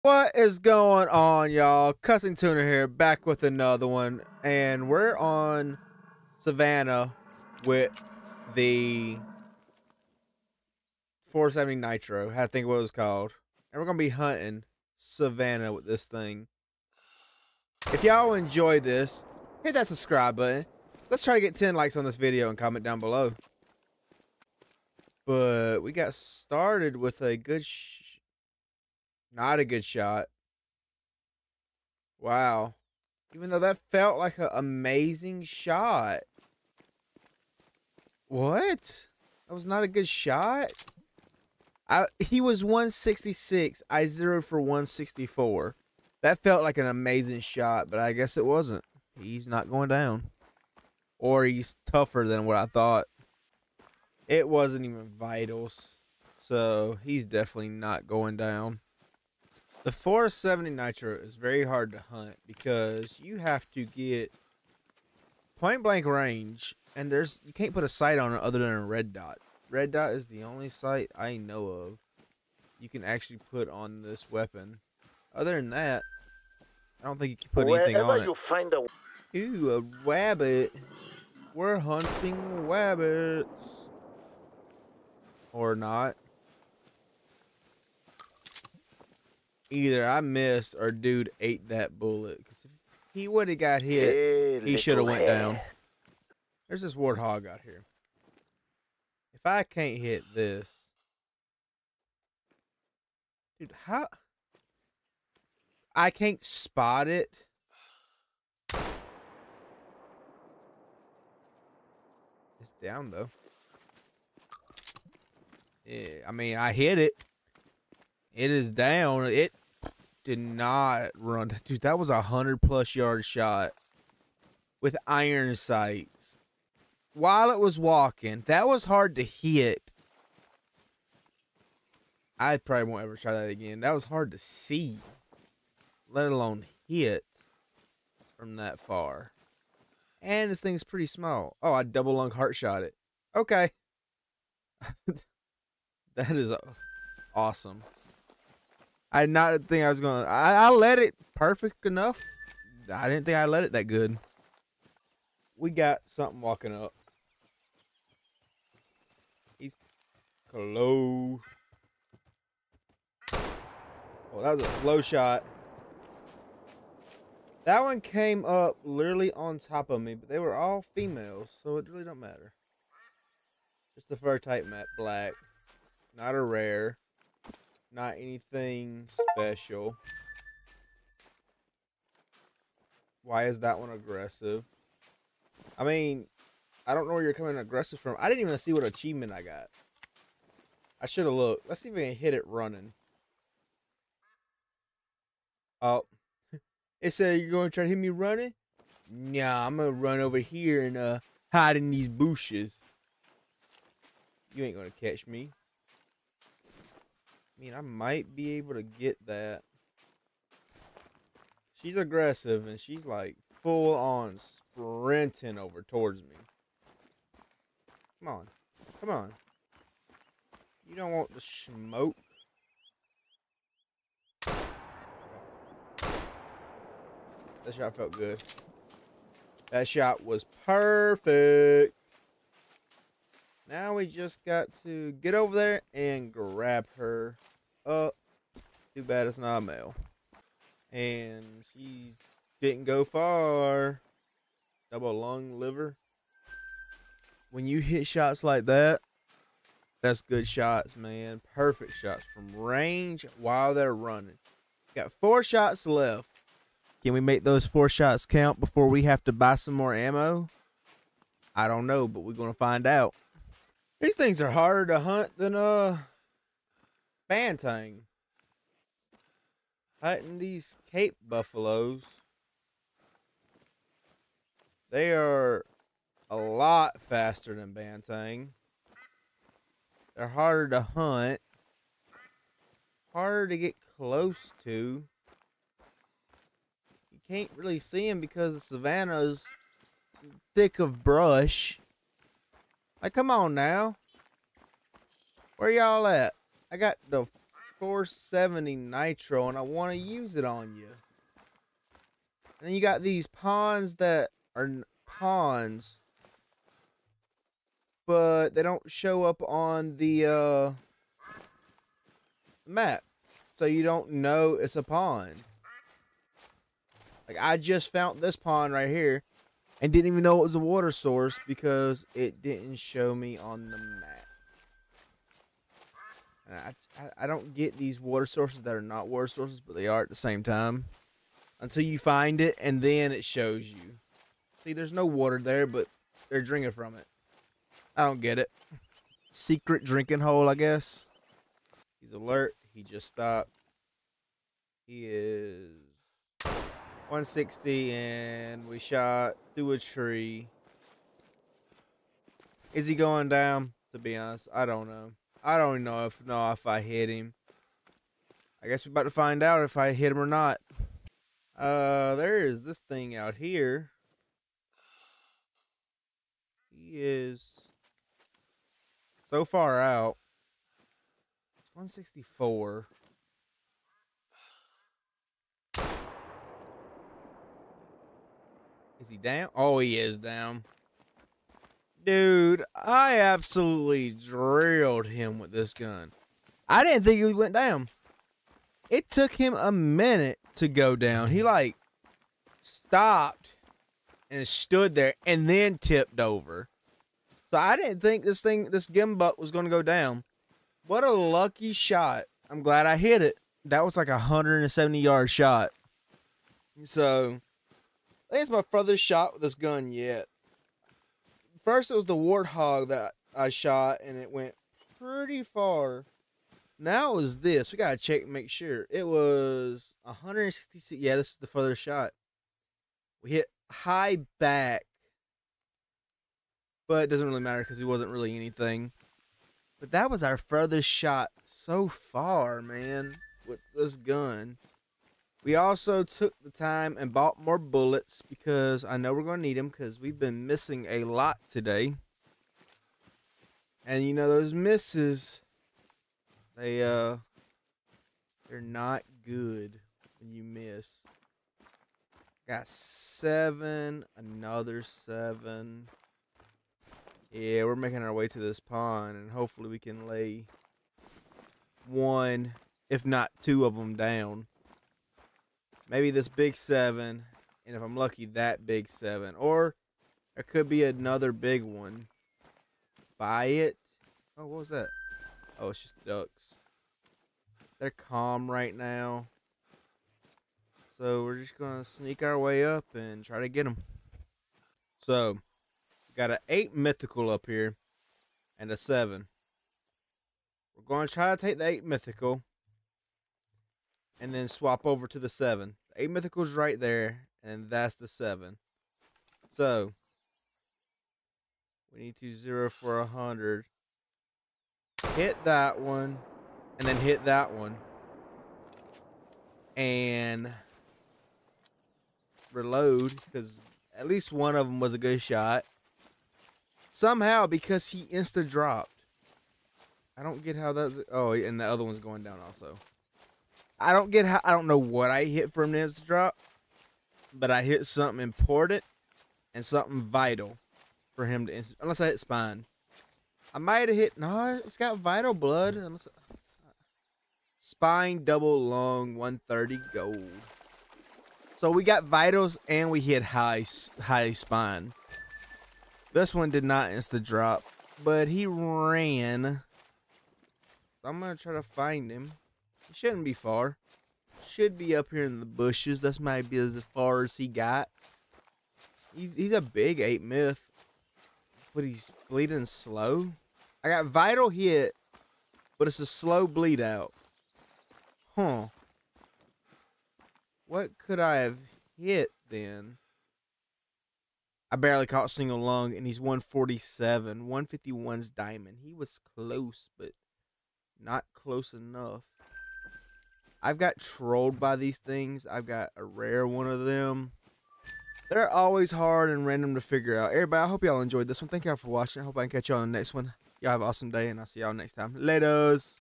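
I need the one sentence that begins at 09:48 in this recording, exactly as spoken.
They're always hard and random to figure out.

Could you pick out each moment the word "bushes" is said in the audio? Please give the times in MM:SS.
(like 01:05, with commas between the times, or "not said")
03:22, 09:15.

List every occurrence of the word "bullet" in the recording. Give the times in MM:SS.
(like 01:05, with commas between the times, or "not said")
01:31, 07:17.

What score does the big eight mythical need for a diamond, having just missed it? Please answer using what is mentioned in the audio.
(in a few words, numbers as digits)
151.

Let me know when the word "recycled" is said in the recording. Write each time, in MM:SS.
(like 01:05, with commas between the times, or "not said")
not said.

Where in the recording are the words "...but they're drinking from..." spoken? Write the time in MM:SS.
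05:35.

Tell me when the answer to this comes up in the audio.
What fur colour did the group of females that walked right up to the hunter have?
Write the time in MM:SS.
02:54.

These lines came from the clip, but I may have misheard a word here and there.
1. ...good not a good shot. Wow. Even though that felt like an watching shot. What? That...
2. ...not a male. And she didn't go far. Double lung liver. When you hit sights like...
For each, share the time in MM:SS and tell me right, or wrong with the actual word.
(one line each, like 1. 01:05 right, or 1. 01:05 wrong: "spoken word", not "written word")
1. 00:27 wrong: "amazing", not "watching"
2. 03:59 wrong: "shots", not "sights".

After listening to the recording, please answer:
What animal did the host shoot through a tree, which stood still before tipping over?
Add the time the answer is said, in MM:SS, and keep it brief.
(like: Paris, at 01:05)
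Gemsbok, at 06:38.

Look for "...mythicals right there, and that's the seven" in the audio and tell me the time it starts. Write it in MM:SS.
08:16.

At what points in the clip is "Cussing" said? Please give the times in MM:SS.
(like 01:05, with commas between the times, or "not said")
00:01.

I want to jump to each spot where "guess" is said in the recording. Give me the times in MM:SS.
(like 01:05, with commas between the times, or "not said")
00:48, 05:40, 05:58.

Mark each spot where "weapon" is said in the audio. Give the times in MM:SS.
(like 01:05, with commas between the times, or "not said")
01:14.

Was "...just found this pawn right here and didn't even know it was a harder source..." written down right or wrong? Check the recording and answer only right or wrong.
wrong.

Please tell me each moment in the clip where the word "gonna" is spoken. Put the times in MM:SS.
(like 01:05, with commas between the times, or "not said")
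00:13, 02:29, 09:11.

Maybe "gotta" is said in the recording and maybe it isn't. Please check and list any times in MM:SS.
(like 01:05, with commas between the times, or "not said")
06:57.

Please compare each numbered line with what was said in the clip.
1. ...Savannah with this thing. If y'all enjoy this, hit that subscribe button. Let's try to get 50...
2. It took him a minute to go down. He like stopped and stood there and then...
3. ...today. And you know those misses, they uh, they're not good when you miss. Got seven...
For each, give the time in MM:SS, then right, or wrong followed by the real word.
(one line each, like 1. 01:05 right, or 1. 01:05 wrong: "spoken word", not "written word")
1. 00:14 wrong: "10", not "50"
2. 06:28 right
3. 07:21 right.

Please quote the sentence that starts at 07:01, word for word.
Yeah, this is the furthest shot.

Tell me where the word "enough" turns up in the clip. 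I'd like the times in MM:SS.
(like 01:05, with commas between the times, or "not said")
02:31, 09:41.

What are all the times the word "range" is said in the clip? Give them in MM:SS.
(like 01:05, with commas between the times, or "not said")
01:06, 04:12.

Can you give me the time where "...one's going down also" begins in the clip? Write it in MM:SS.
08:41.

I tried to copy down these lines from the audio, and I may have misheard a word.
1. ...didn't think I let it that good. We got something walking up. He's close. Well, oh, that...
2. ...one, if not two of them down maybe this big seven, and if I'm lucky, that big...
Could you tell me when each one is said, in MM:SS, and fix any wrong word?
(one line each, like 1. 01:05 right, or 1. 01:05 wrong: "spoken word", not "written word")
1. 02:33 right
2. 07:41 right.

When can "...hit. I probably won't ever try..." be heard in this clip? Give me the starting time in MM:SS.
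02:09.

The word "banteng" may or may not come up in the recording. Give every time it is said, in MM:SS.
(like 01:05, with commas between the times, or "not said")
04:27, 04:37.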